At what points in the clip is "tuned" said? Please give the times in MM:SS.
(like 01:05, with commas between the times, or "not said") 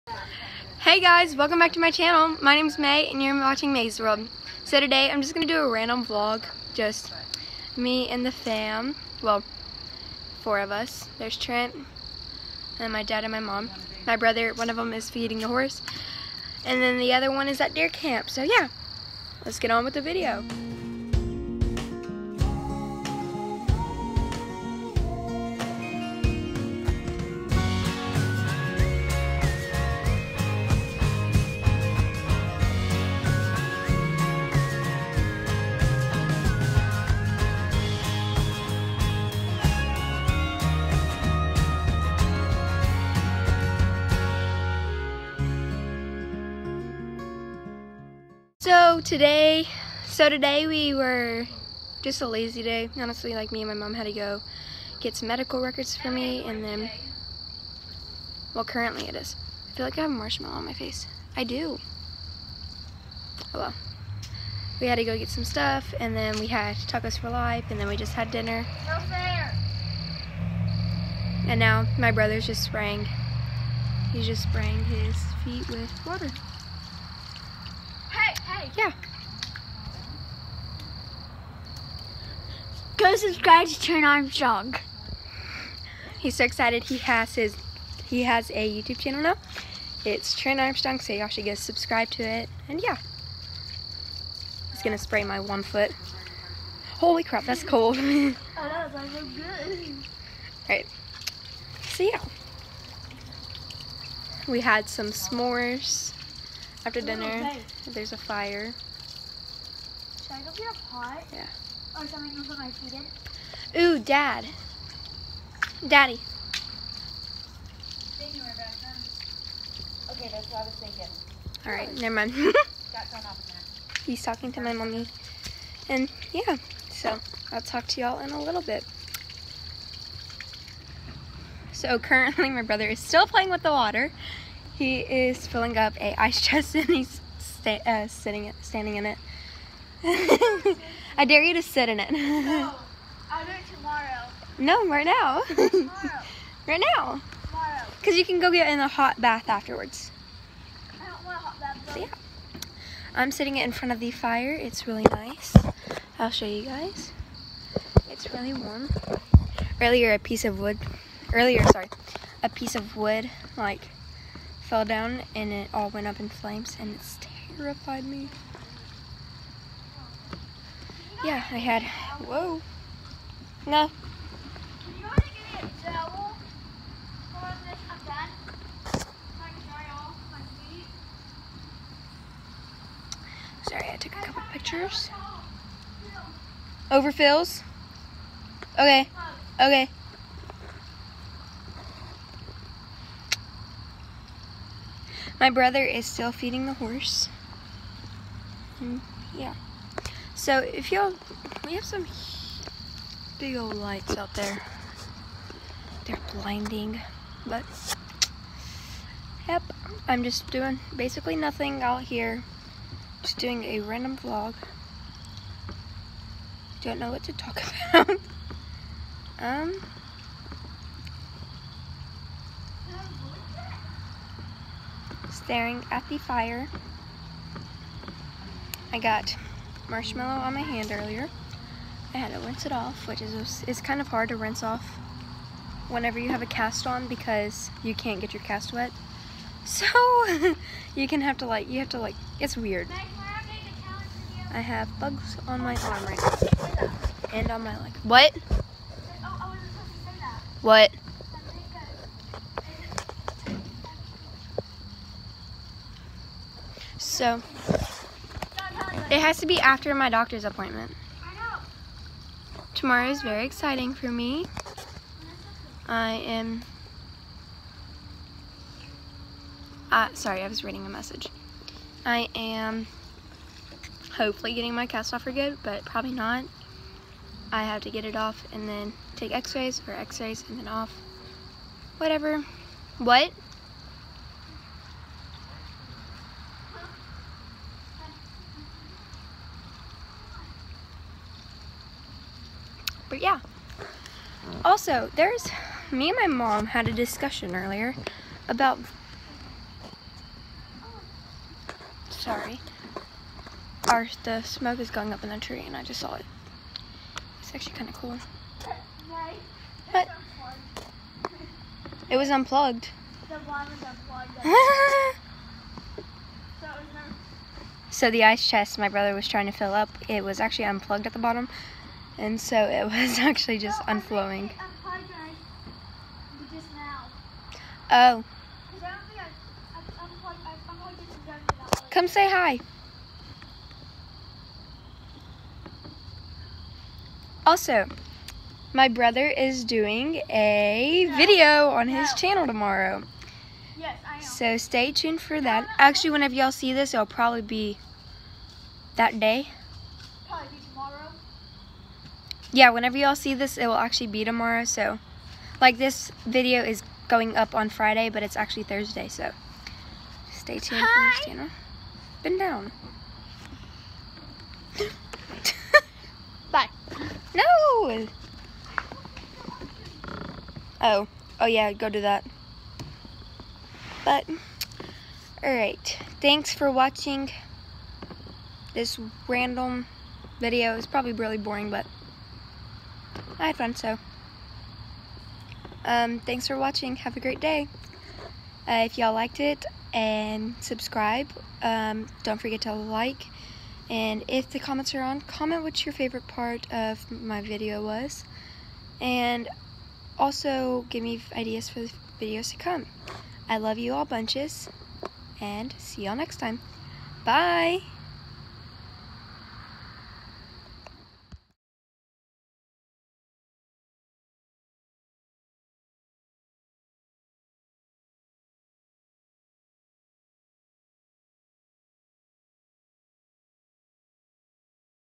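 05:44, 06:00.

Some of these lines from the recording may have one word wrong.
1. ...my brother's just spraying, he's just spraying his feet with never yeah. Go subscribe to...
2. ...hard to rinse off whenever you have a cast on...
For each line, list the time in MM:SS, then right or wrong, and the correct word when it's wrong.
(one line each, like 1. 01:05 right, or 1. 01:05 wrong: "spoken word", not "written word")
1. 01:11 wrong: "water", not "never"
2. 03:54 right.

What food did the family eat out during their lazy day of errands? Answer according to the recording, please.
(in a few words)
tacos.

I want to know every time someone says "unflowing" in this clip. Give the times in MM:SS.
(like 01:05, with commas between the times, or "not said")
05:23.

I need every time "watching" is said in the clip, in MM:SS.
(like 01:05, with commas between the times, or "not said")
00:03, 06:16, 06:26.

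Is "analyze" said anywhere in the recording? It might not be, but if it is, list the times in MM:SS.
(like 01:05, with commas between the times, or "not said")
not said.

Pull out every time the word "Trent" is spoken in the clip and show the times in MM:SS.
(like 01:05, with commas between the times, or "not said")
00:11, 01:23, 01:30.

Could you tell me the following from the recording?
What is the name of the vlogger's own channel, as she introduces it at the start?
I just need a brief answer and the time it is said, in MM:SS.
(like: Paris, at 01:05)
Mae's World, at 00:03.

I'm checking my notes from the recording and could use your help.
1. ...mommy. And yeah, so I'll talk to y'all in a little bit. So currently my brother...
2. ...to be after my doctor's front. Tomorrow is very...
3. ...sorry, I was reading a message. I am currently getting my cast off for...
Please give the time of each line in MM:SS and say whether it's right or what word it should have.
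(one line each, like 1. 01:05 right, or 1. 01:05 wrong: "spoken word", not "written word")
1. 02:04 right
2. 04:19 wrong: "appointment", not "front"
3. 04:30 wrong: "hopefully", not "currently".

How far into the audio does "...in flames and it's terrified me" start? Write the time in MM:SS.
02:46.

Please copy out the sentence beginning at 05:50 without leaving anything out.
Probably yeah, whenever y'all see this, it will actually be tomorrow.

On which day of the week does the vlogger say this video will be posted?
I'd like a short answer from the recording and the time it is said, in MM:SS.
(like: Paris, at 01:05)
Friday, at 05:57.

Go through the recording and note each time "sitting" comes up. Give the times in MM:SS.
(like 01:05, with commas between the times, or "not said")
02:18, 02:33.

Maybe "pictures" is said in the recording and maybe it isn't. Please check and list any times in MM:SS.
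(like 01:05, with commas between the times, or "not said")
03:04.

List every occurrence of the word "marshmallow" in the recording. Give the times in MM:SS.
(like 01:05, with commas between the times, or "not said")
01:00, 03:49.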